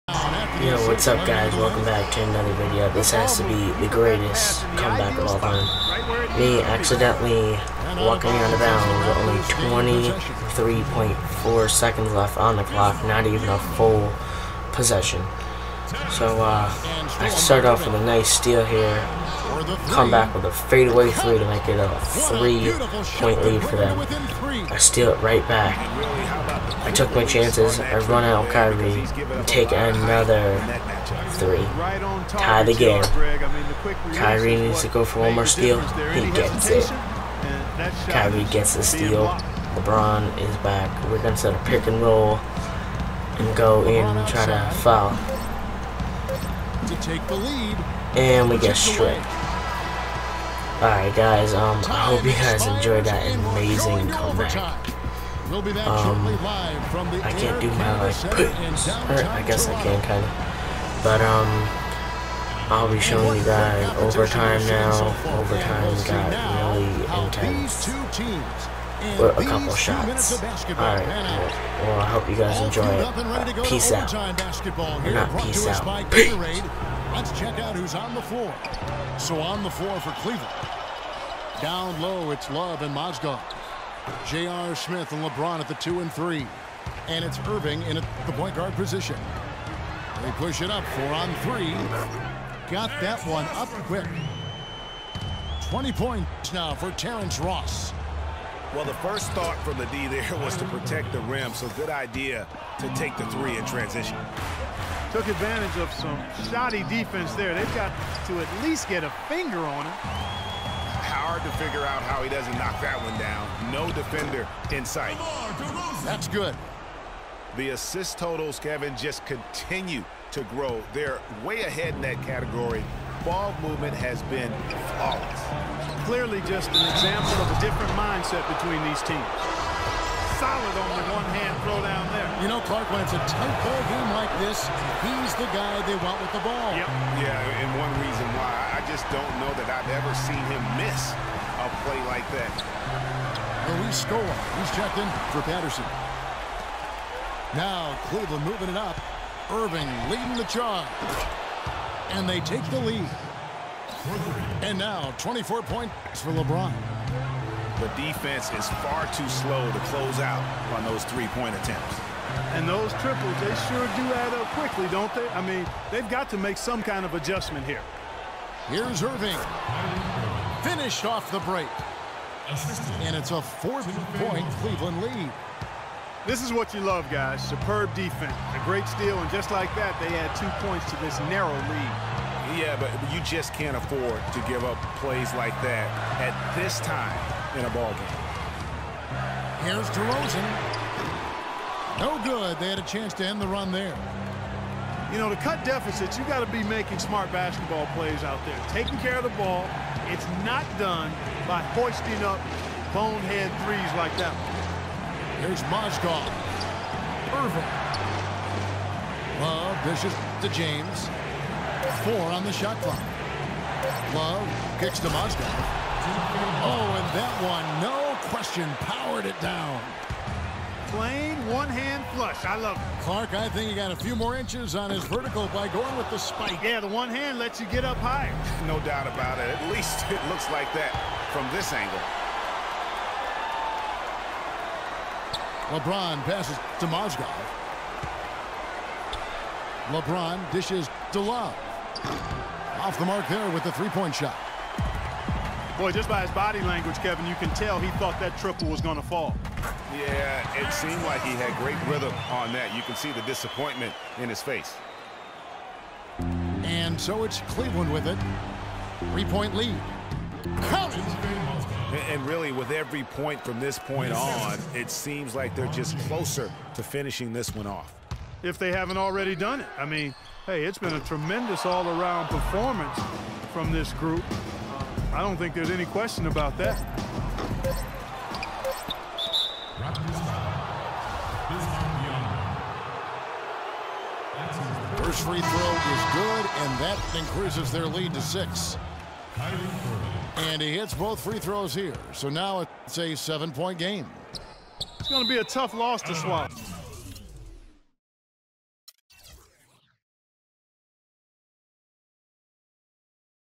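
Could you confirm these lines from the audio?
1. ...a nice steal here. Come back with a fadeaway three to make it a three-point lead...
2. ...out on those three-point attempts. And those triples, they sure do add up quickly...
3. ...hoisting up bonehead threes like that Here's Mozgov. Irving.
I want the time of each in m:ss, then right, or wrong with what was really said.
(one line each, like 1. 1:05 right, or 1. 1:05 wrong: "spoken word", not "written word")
1. 0:17 right
2. 2:40 right
3. 3:21 right.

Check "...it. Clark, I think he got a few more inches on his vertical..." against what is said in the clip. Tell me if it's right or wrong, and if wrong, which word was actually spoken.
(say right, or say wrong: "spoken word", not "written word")
right.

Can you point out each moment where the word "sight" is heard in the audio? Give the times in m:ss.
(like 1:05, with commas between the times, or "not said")
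1:54.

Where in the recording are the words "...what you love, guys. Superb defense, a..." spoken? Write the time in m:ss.
2:56.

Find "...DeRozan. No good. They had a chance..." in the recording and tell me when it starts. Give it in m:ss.
3:09.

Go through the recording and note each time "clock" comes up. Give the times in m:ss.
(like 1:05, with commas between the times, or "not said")
0:12, 3:32.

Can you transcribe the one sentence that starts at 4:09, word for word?
Yeah, it seemed like he had great rhythm on that.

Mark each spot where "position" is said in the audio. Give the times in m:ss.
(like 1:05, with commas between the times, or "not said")
1:28.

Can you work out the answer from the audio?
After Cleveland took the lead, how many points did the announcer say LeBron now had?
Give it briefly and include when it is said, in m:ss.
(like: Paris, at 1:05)
24, at 2:35.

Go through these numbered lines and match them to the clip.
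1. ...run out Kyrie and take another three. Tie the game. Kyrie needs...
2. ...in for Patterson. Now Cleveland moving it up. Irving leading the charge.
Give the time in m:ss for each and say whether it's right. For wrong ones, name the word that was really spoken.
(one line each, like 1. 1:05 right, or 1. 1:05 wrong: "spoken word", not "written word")
1. 0:28 right
2. 2:24 right.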